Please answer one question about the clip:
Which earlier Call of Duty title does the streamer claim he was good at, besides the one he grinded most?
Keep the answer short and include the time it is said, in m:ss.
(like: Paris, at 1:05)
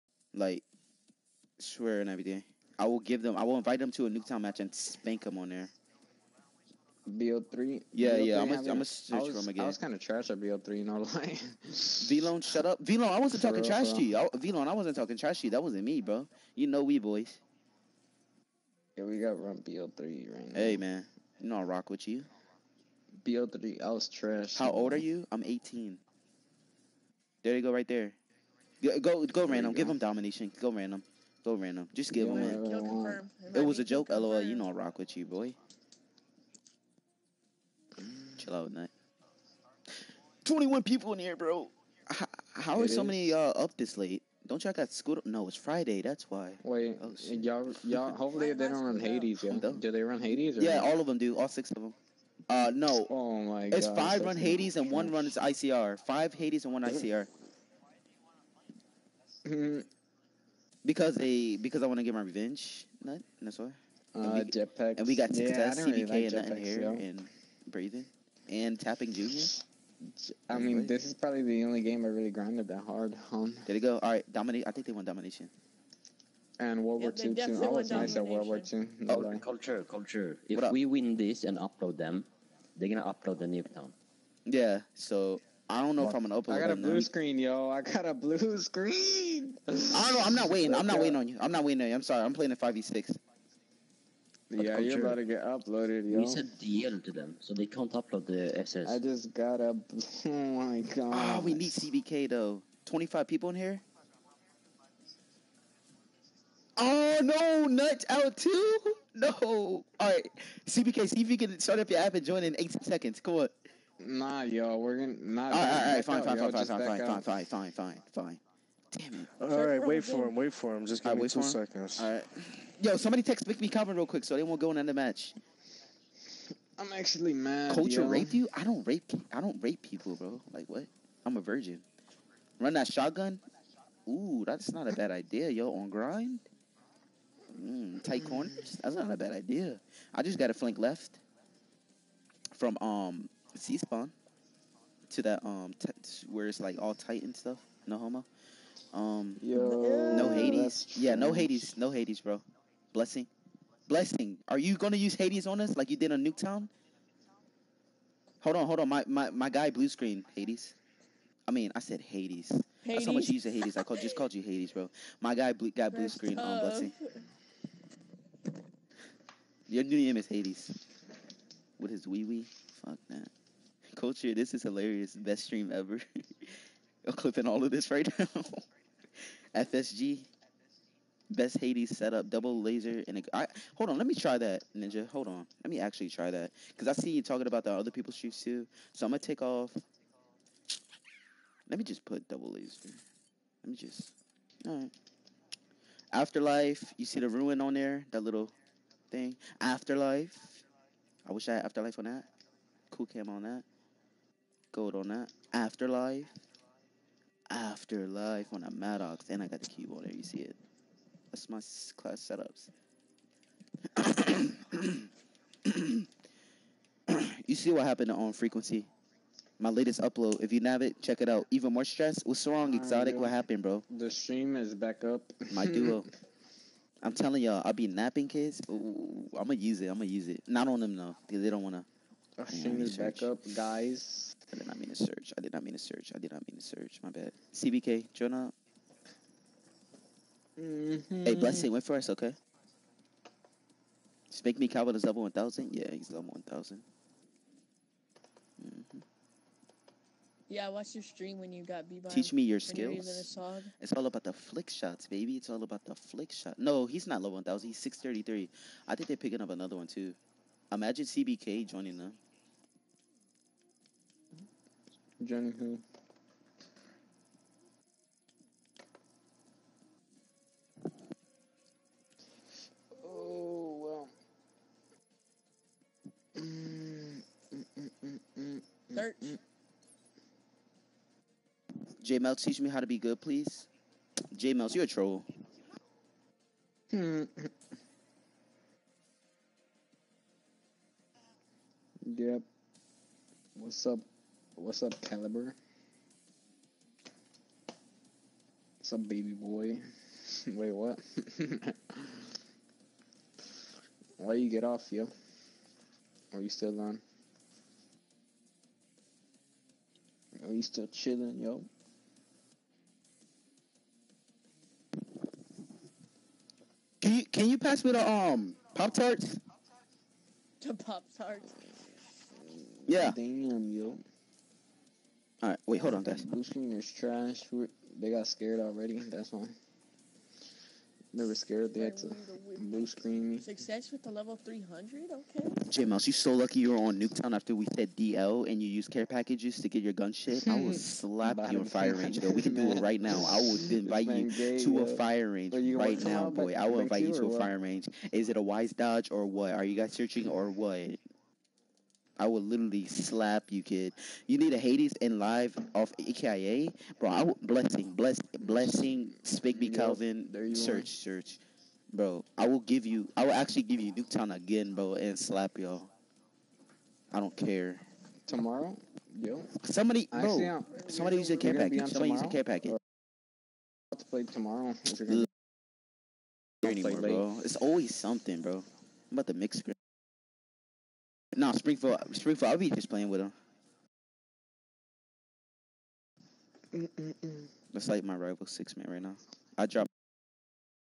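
World War II, at 1:18.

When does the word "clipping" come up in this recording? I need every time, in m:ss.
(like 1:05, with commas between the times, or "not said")
2:57.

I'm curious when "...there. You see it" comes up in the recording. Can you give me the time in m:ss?
3:30.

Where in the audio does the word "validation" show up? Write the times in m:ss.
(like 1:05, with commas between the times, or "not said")
not said.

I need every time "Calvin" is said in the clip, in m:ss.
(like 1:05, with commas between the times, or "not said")
2:03, 4:04, 5:59.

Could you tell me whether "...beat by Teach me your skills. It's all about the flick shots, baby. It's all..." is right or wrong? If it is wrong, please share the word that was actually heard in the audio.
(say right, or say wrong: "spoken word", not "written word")
right.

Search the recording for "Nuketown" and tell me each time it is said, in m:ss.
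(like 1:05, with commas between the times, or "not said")
0:04, 1:23, 2:36, 5:37, 6:03.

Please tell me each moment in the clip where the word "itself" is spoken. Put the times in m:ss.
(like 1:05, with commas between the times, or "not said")
not said.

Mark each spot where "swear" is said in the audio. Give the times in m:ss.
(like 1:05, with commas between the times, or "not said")
0:01.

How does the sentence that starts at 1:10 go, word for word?
I mean, this is probably the only game I really grinded that hard on.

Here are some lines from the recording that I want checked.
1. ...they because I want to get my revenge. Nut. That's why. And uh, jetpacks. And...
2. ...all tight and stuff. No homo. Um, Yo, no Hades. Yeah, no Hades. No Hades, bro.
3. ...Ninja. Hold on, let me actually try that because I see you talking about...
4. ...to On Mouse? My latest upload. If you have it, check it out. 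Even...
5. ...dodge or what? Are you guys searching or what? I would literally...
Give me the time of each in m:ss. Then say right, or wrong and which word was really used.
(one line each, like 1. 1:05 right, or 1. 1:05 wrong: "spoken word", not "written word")
1. 1:01 right
2. 2:26 right
3. 3:04 right
4. 3:38 wrong: "Frequency", not "Mouse"
5. 5:48 right.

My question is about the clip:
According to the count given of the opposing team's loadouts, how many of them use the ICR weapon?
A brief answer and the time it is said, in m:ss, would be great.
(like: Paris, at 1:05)
1, at 0:54.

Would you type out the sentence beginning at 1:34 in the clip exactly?
Yeah, you're about to get uploaded, yo.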